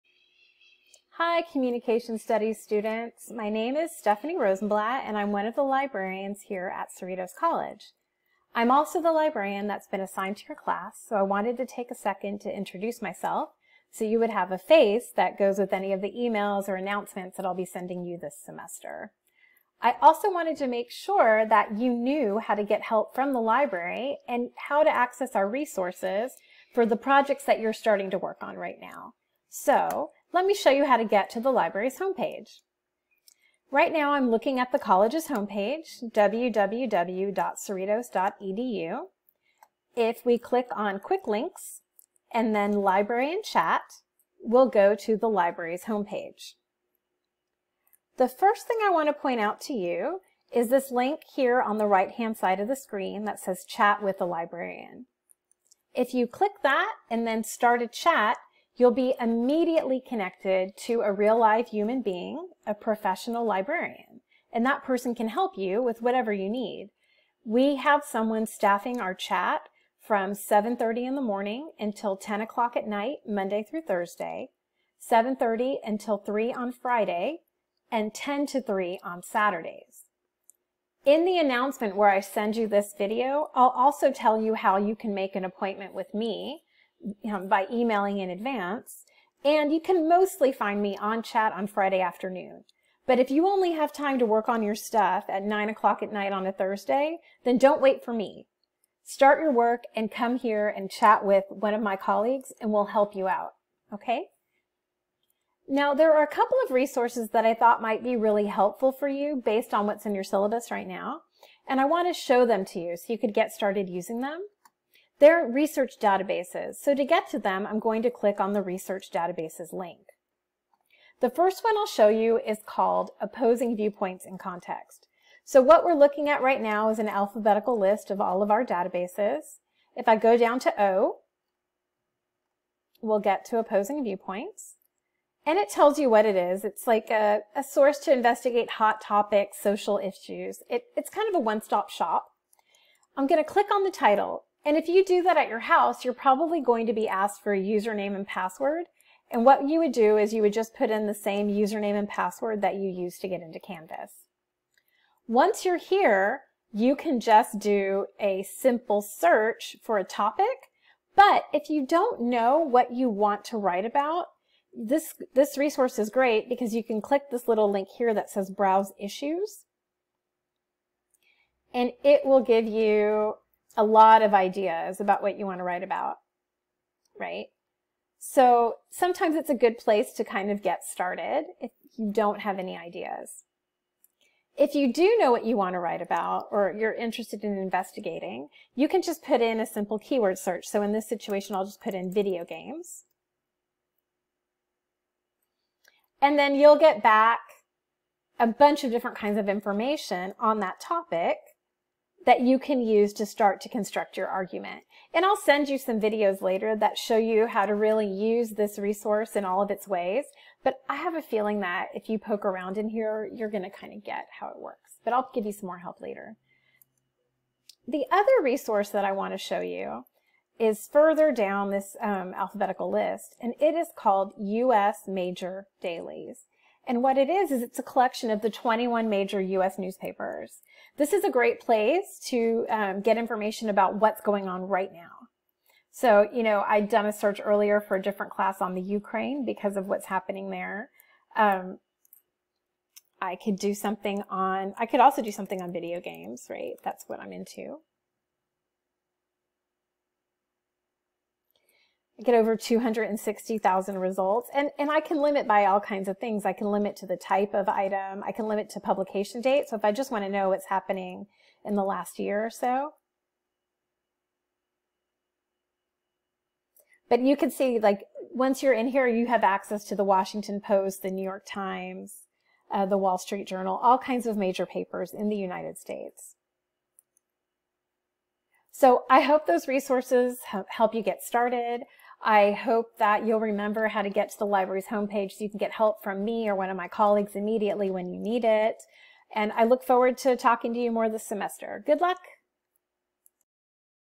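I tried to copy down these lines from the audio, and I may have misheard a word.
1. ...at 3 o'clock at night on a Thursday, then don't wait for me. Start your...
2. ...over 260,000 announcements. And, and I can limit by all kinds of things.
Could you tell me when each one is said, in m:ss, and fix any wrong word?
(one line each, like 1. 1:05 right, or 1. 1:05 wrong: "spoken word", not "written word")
1. 1:35 wrong: "9", not "3"
2. 4:12 wrong: "results", not "announcements".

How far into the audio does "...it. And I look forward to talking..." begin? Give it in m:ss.
4:48.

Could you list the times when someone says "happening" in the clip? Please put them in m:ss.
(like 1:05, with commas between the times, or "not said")
4:00, 4:20.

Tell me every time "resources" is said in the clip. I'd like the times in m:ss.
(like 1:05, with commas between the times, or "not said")
0:25, 1:46, 2:45, 3:28, 3:38, 4:39.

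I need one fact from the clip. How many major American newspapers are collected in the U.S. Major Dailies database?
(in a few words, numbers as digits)
21.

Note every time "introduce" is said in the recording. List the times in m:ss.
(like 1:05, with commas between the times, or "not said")
0:12.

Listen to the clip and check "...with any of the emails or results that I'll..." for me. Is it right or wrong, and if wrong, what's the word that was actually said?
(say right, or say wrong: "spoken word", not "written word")
wrong: "announcements", not "results".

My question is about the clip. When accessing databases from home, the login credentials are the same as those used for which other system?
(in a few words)
Canvas.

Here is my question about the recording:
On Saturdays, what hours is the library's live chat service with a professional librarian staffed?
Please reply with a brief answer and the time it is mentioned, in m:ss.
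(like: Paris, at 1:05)
10 to 3, at 1:18.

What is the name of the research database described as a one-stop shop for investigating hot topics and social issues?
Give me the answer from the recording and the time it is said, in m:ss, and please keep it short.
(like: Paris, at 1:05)
Opposing Viewpoints in Context, at 2:03.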